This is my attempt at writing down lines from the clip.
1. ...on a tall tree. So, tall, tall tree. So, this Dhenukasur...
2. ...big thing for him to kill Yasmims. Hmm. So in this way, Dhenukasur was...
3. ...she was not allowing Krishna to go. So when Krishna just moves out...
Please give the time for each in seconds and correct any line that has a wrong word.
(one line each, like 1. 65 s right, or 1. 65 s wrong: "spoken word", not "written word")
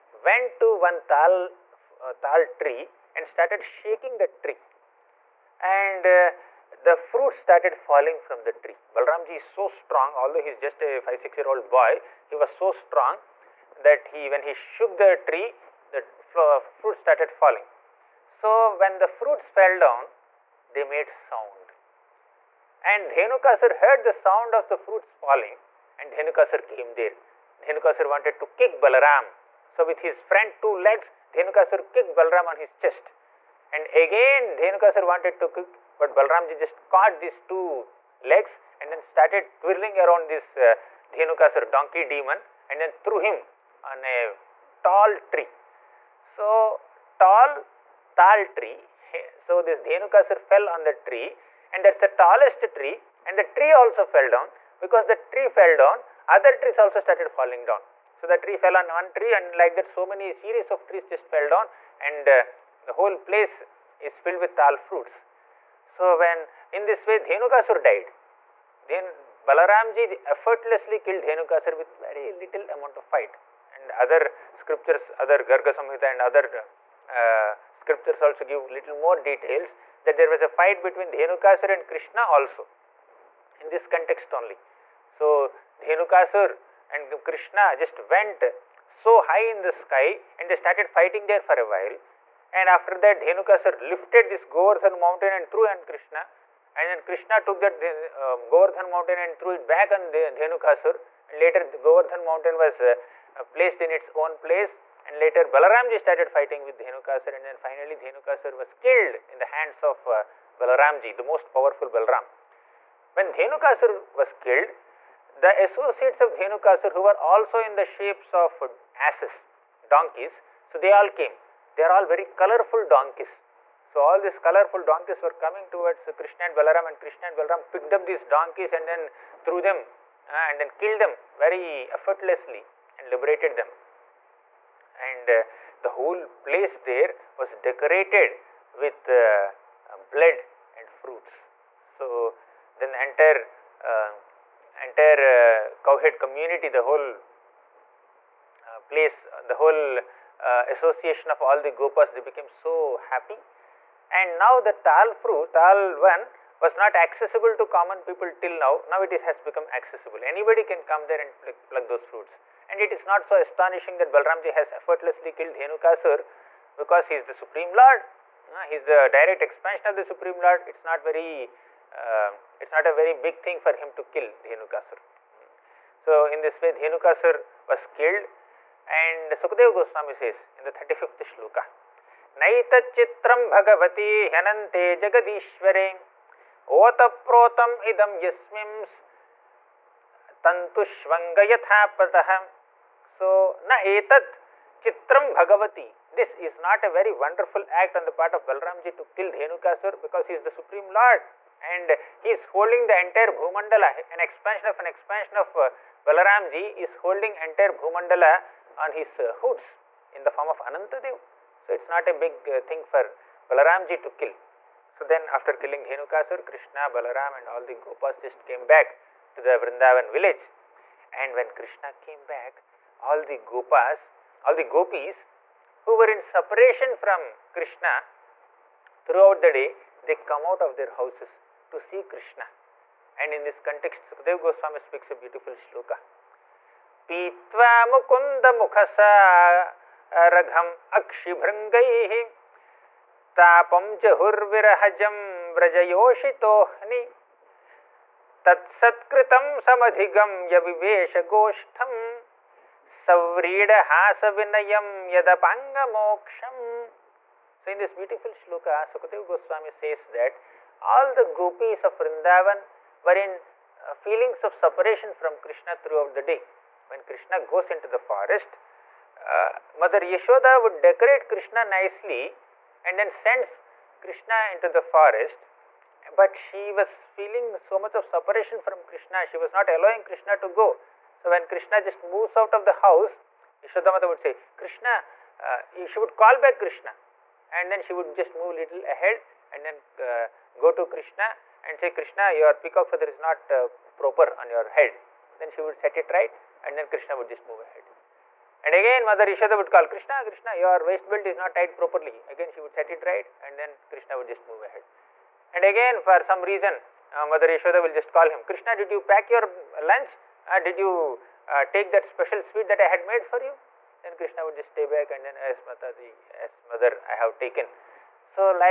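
1. 43 s right
2. 173 s wrong: "Dhenukasur", not "Yasmims"
3. 279 s right.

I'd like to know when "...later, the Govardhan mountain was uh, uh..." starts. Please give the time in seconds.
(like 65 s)
101 s.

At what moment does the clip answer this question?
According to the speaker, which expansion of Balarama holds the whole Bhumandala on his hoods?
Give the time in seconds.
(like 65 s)
210 s.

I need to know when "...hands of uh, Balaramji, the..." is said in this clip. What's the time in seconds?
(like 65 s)
109 s.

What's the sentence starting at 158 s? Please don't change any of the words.
Now it is, has become accessible.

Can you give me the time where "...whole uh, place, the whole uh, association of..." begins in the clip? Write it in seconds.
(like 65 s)
146 s.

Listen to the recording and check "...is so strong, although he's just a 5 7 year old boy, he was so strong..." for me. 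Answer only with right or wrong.
wrong.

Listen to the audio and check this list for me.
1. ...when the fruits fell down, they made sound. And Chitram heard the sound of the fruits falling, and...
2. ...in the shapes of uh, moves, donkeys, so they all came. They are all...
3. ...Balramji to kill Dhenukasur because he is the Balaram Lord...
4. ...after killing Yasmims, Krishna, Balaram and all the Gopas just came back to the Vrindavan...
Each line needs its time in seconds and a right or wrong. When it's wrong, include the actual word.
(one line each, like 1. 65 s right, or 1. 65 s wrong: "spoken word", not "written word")
1. 18 s wrong: "Dhenukasur", not "Chitram"
2. 117 s wrong: "asses", not "moves"
3. 198 s wrong: "Supreme", not "Balaram"
4. 215 s wrong: "Dhenukasur", not "Yasmims".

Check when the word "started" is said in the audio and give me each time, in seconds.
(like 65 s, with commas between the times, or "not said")
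3 s, 7 s, 16 s, 39 s, 56 s, 90 s, 105 s.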